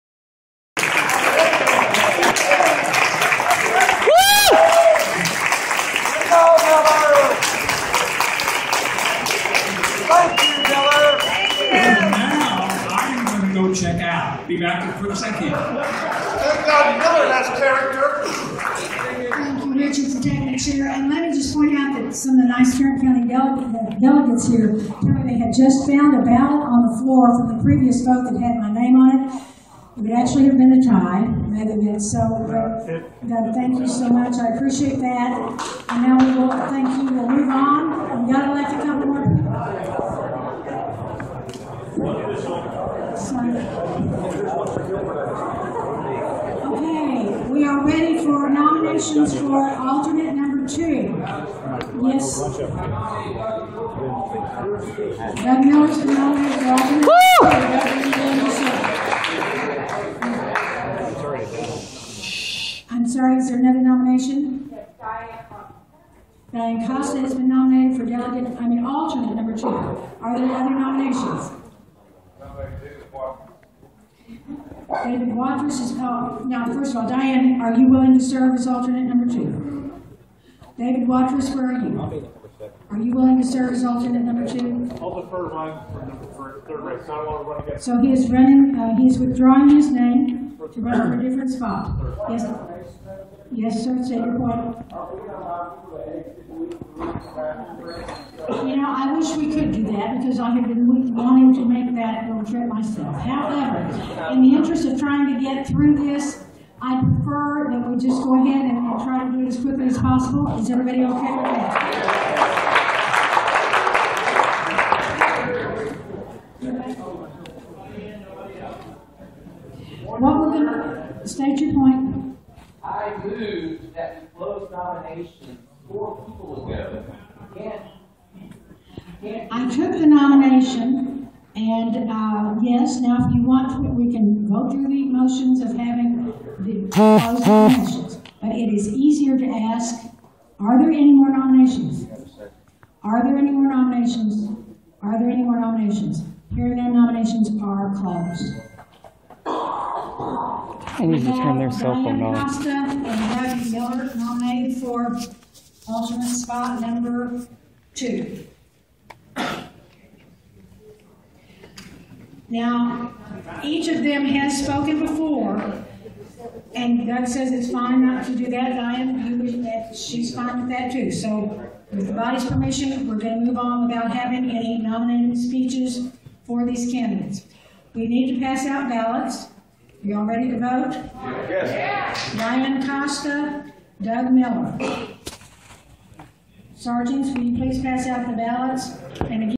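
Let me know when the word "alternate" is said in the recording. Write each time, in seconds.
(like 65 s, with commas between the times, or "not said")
49 s, 68 s, 78 s, 83 s, 155 s.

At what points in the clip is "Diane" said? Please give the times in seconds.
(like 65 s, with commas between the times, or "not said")
66 s, 77 s, 168 s, 182 s.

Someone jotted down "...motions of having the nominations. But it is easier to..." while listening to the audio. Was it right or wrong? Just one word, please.
right.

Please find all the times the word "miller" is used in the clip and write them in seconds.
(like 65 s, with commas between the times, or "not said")
16 s, 55 s, 153 s, 184 s.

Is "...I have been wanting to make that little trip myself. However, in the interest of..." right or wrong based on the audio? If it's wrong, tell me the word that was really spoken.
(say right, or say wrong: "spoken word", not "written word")
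right.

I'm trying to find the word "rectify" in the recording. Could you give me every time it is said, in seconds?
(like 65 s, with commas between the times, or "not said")
not said.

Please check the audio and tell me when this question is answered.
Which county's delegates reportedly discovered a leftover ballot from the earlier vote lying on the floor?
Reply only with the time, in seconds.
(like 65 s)
22 s.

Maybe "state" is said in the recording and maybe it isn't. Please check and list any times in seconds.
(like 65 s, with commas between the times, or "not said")
94 s, 121 s.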